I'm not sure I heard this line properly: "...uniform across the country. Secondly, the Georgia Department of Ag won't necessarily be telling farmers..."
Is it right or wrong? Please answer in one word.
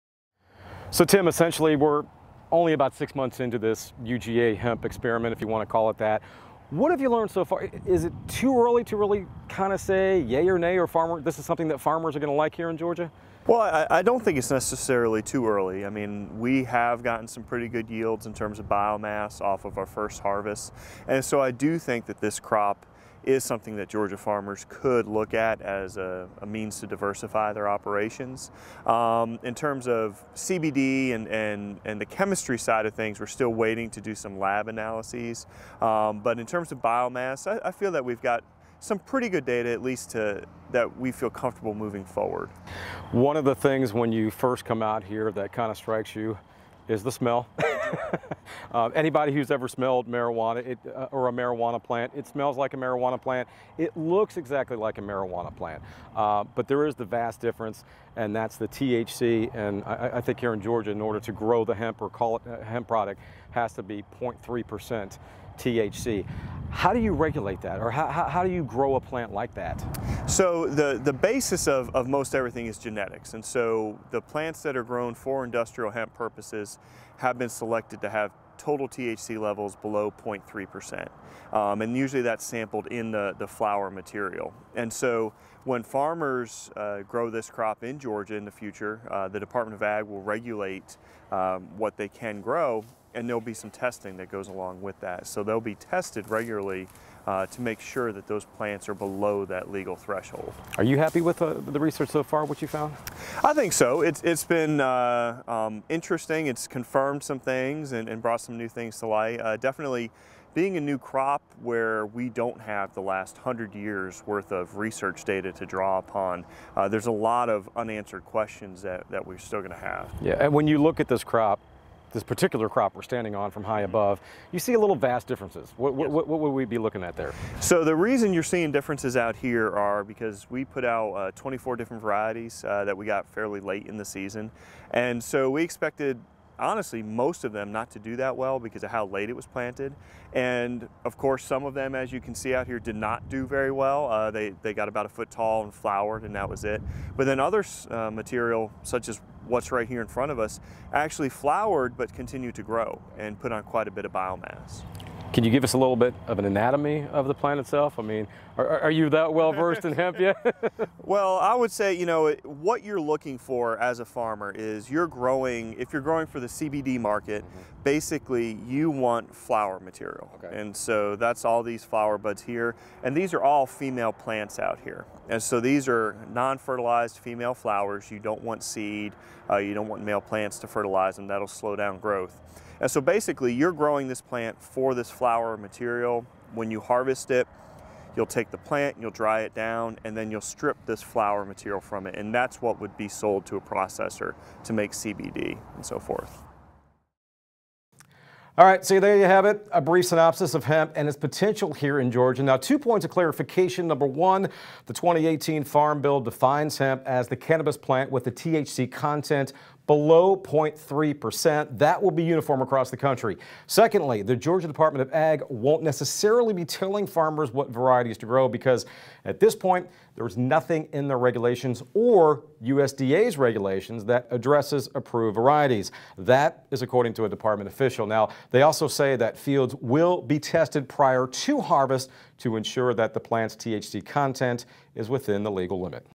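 right.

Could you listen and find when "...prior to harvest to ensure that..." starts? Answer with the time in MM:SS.
03:50.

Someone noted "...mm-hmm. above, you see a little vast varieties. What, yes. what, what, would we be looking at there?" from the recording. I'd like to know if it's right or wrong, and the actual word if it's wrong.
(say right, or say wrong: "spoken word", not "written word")
wrong: "differences", not "varieties".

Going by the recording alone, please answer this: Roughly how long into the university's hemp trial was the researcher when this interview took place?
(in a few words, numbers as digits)
6 months.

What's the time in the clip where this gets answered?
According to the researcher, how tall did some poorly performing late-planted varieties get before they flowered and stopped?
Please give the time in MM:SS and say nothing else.
02:25.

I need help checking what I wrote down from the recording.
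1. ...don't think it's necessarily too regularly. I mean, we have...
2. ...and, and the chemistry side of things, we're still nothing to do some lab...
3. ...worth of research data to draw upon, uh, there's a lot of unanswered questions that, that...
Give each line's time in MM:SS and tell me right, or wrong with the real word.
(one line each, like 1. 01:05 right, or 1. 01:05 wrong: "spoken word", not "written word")
1. 00:14 wrong: "early", not "regularly"
2. 00:31 wrong: "waiting", not "nothing"
3. 01:54 right.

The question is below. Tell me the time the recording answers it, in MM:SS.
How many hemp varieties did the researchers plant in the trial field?
02:11.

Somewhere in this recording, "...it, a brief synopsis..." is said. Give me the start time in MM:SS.
03:19.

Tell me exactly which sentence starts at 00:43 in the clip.
One of the things when you first come out here that kind of strikes you is the smell.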